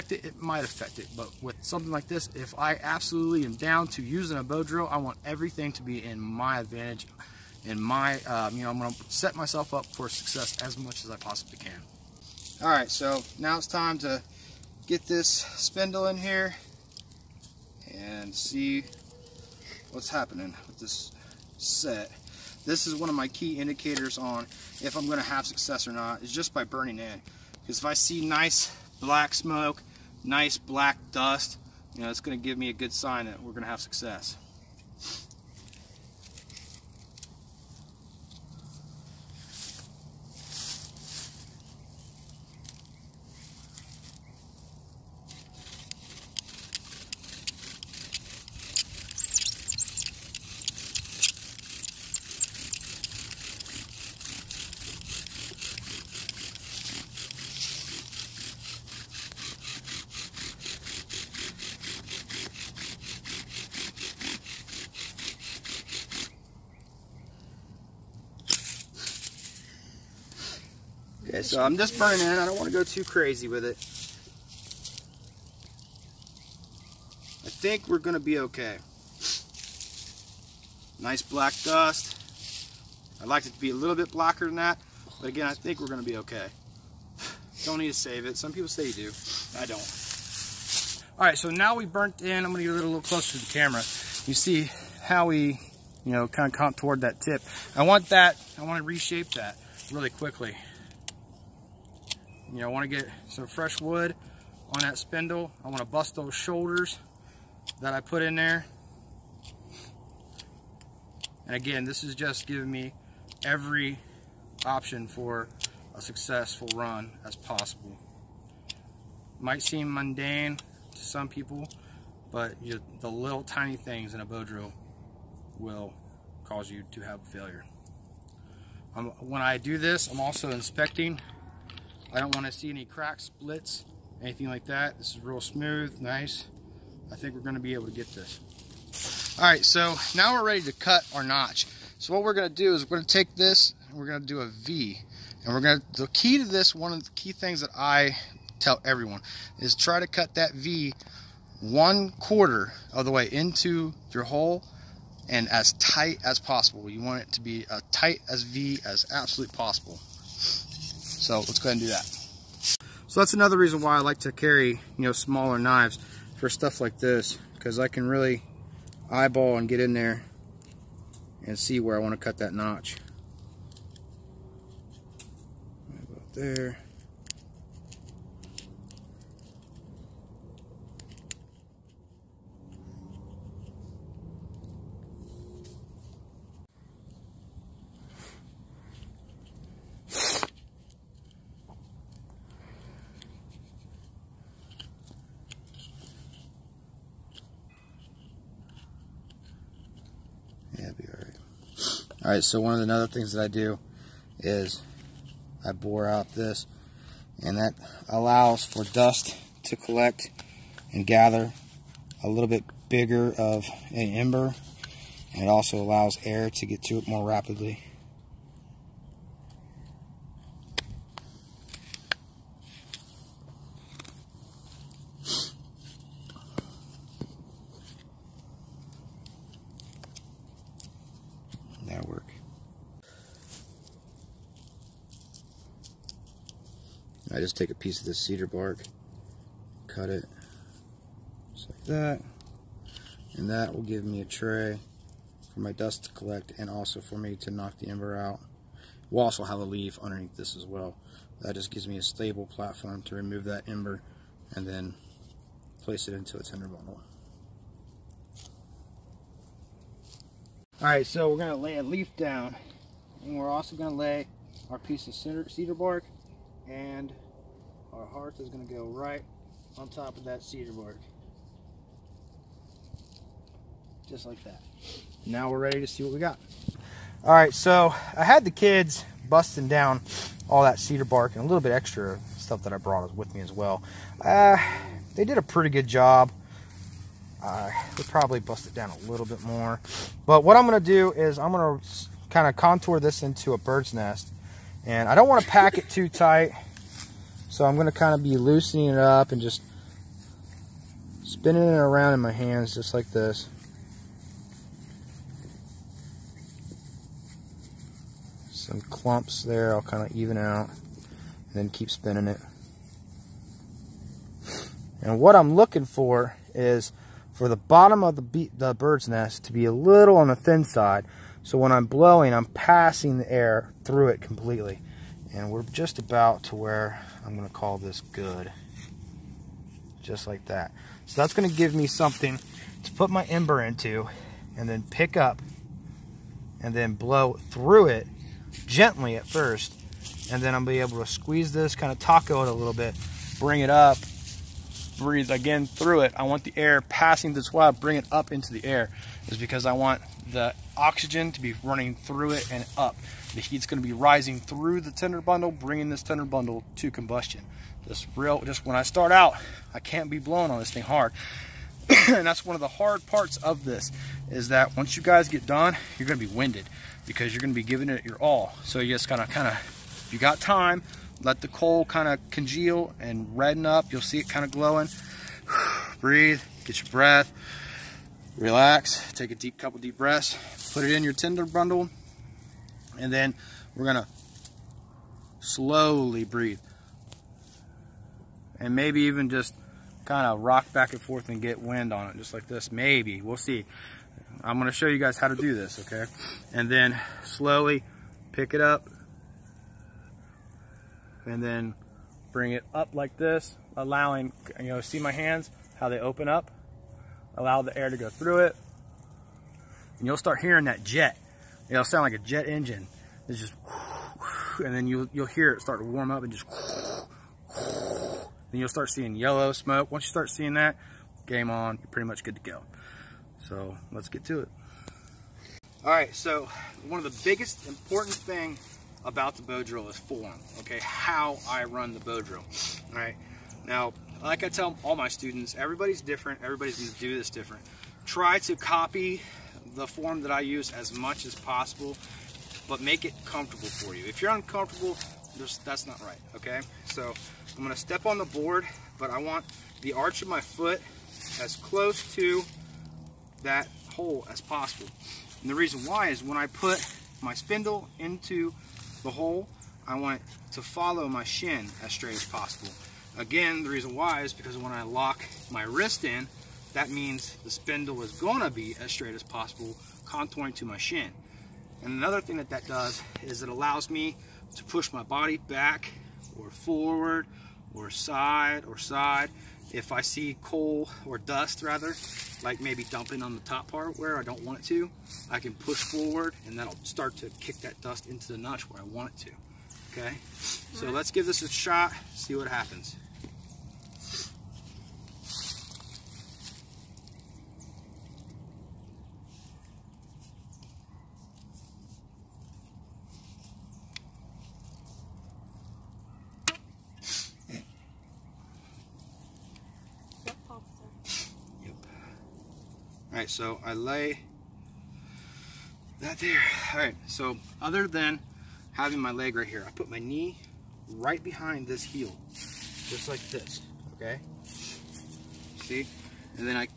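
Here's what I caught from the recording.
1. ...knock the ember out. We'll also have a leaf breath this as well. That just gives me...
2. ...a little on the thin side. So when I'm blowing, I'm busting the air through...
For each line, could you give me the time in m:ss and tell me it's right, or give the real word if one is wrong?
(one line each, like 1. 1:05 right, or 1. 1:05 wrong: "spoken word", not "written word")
1. 4:07 wrong: "underneath", not "breath"
2. 5:19 wrong: "passing", not "busting".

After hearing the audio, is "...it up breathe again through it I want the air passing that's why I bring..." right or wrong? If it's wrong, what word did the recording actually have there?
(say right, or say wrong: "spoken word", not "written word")
right.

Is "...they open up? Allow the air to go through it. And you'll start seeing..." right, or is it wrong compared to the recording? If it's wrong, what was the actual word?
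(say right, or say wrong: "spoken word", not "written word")
wrong: "hearing", not "seeing".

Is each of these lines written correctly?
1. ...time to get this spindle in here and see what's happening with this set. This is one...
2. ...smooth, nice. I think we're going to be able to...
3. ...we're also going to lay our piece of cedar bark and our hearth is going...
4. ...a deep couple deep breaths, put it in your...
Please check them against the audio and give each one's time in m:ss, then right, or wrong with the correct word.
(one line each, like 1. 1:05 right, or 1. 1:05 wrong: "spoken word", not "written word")
1. 0:13 right
2. 2:15 right
3. 4:23 right
4. 6:19 right.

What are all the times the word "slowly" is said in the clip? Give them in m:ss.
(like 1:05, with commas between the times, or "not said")
6:25, 6:37.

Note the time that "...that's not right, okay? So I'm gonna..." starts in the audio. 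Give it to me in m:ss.
7:25.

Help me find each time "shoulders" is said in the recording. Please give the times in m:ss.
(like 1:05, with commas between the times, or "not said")
1:46.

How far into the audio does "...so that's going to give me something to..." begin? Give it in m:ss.
5:31.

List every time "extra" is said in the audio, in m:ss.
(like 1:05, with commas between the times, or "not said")
4:41.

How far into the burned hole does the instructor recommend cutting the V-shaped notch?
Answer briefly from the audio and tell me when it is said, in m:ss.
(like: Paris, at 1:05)
One quarter, at 2:31.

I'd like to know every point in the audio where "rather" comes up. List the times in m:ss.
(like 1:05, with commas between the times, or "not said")
8:01.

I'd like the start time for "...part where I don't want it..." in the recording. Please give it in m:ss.
8:03.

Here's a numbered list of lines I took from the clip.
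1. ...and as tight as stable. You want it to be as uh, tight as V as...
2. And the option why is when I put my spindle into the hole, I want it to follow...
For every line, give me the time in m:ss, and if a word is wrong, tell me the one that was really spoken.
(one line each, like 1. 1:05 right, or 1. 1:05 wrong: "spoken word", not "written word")
1. 2:35 wrong: "possible", not "stable"
2. 7:35 wrong: "reason", not "option".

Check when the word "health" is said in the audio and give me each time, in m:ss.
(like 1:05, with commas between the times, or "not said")
not said.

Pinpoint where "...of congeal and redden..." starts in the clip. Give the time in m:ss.
6:12.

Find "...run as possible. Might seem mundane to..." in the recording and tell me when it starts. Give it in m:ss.
1:56.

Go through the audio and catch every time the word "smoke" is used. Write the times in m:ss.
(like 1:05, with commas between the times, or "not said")
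0:29, 6:59.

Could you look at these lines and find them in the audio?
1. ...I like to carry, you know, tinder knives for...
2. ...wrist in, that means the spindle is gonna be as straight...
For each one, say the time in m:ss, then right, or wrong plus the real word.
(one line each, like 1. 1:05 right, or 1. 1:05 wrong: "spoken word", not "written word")
1. 2:43 wrong: "smaller", not "tinder"
2. 7:45 right.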